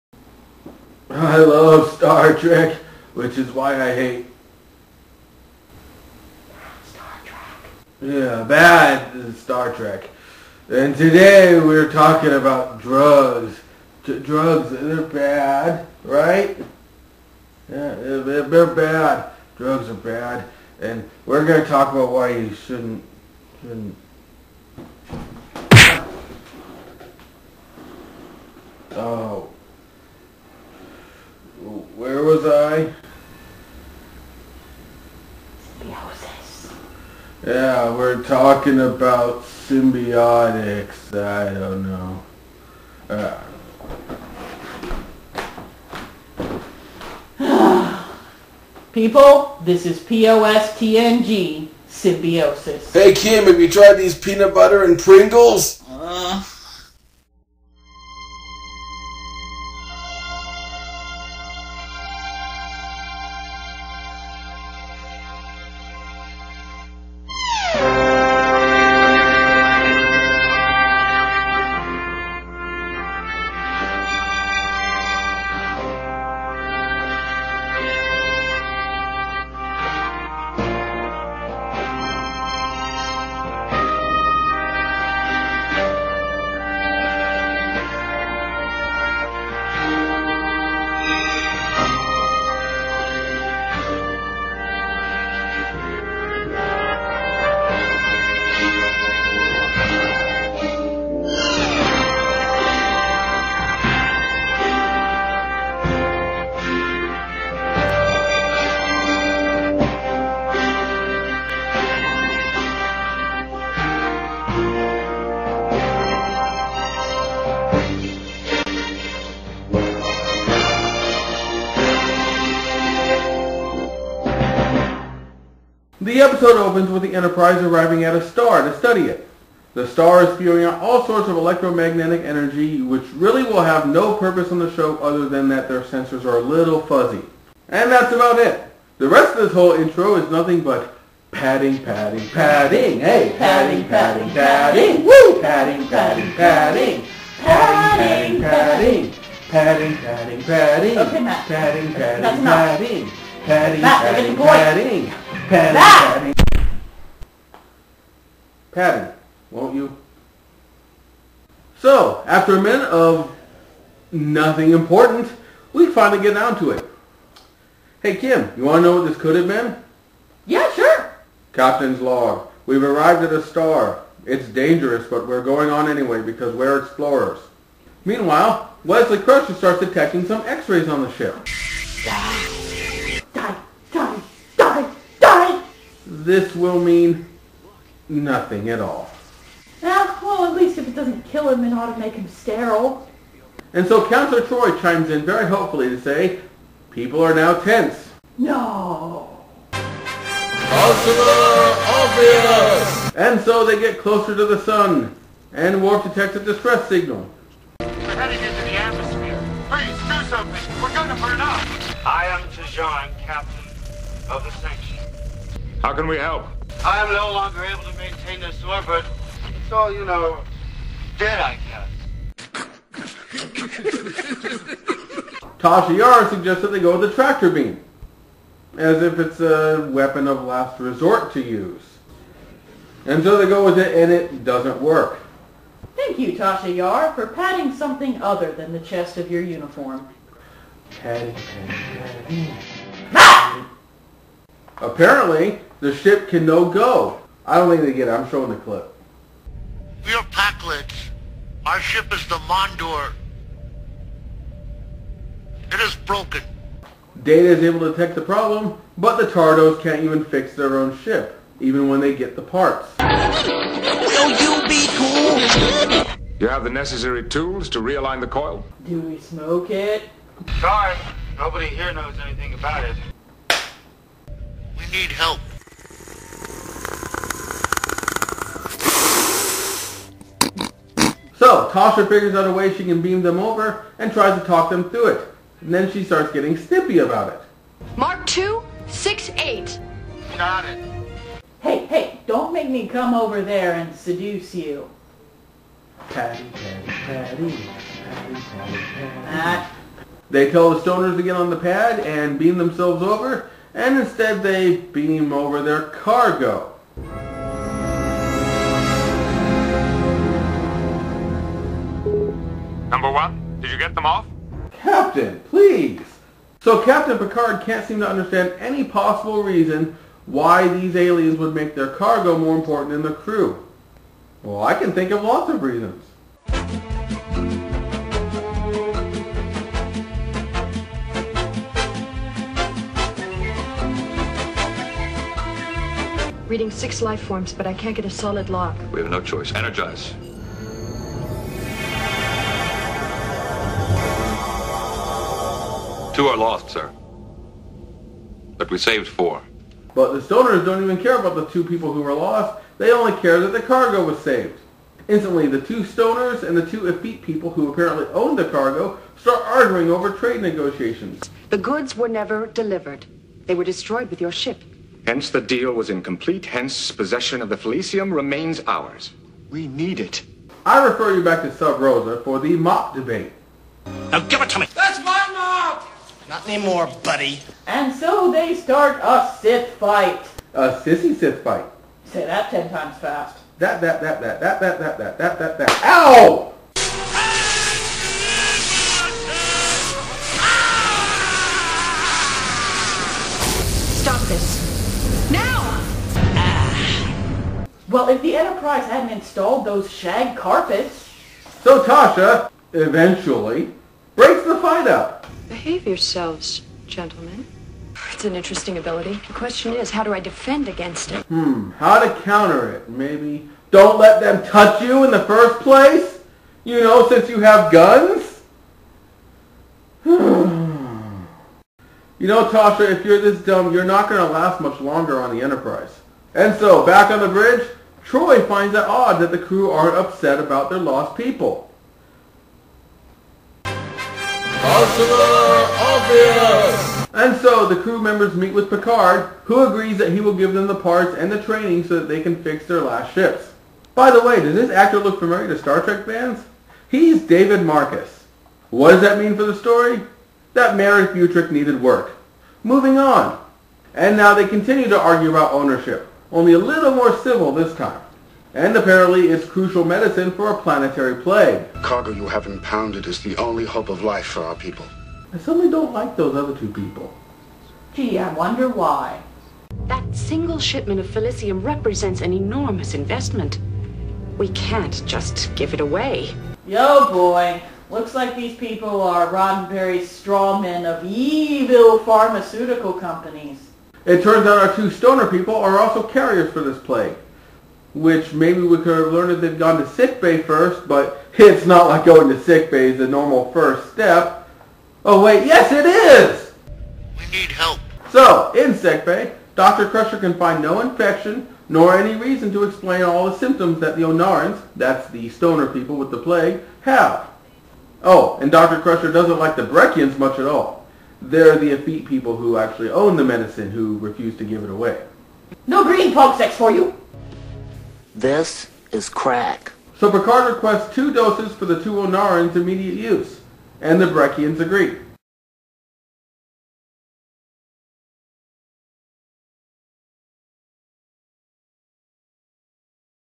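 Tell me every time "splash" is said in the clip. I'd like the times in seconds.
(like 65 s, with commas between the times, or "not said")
not said.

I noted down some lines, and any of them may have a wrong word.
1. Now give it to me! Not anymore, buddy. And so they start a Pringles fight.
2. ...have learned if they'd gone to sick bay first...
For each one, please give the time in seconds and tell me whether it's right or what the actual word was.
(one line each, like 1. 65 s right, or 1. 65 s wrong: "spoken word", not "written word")
1. 374 s wrong: "Sith", not "Pringles"
2. 489 s right.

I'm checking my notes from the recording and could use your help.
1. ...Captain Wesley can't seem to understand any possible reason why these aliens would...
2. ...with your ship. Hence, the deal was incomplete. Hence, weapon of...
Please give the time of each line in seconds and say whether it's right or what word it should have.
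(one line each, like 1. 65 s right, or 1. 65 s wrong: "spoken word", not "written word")
1. 316 s wrong: "Picard", not "Wesley"
2. 364 s wrong: "possession", not "weapon".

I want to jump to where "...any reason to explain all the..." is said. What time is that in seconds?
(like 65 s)
501 s.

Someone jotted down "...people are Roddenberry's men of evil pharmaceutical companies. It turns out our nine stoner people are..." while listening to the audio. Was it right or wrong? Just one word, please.
wrong.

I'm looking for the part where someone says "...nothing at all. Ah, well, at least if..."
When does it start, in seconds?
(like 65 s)
188 s.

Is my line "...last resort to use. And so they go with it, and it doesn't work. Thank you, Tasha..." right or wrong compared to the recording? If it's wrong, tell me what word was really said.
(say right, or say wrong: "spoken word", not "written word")
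right.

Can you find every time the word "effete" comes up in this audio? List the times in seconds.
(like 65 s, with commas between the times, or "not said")
356 s, 511 s.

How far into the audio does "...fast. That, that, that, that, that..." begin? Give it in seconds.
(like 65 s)
382 s.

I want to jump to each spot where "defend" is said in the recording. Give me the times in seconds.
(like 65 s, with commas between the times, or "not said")
410 s.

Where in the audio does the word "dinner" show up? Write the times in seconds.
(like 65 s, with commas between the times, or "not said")
not said.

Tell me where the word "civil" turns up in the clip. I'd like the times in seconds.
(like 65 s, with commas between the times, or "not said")
457 s.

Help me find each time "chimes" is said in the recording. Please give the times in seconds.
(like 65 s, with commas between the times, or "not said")
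194 s.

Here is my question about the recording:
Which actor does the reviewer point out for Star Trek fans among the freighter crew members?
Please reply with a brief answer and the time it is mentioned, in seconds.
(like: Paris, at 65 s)
Merritt Butrick, at 450 s.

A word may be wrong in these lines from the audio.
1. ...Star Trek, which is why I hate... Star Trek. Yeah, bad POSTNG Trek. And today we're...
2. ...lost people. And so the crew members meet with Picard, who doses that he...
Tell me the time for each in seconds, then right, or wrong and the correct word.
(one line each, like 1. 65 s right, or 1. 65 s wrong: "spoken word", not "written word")
1. 1 s wrong: "Star", not "POSTNG"
2. 430 s wrong: "agrees", not "doses".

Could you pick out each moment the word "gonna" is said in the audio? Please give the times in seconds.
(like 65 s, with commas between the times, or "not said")
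210 s.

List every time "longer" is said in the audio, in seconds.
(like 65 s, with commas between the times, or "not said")
217 s, 424 s.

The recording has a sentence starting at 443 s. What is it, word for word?
By the way, does this actor look familiar to Star Trek fans?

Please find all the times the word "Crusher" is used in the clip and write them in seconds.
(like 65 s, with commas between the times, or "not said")
179 s, 499 s, 508 s.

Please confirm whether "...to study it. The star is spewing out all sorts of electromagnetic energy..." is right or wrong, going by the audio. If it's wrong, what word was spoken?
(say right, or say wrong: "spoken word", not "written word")
right.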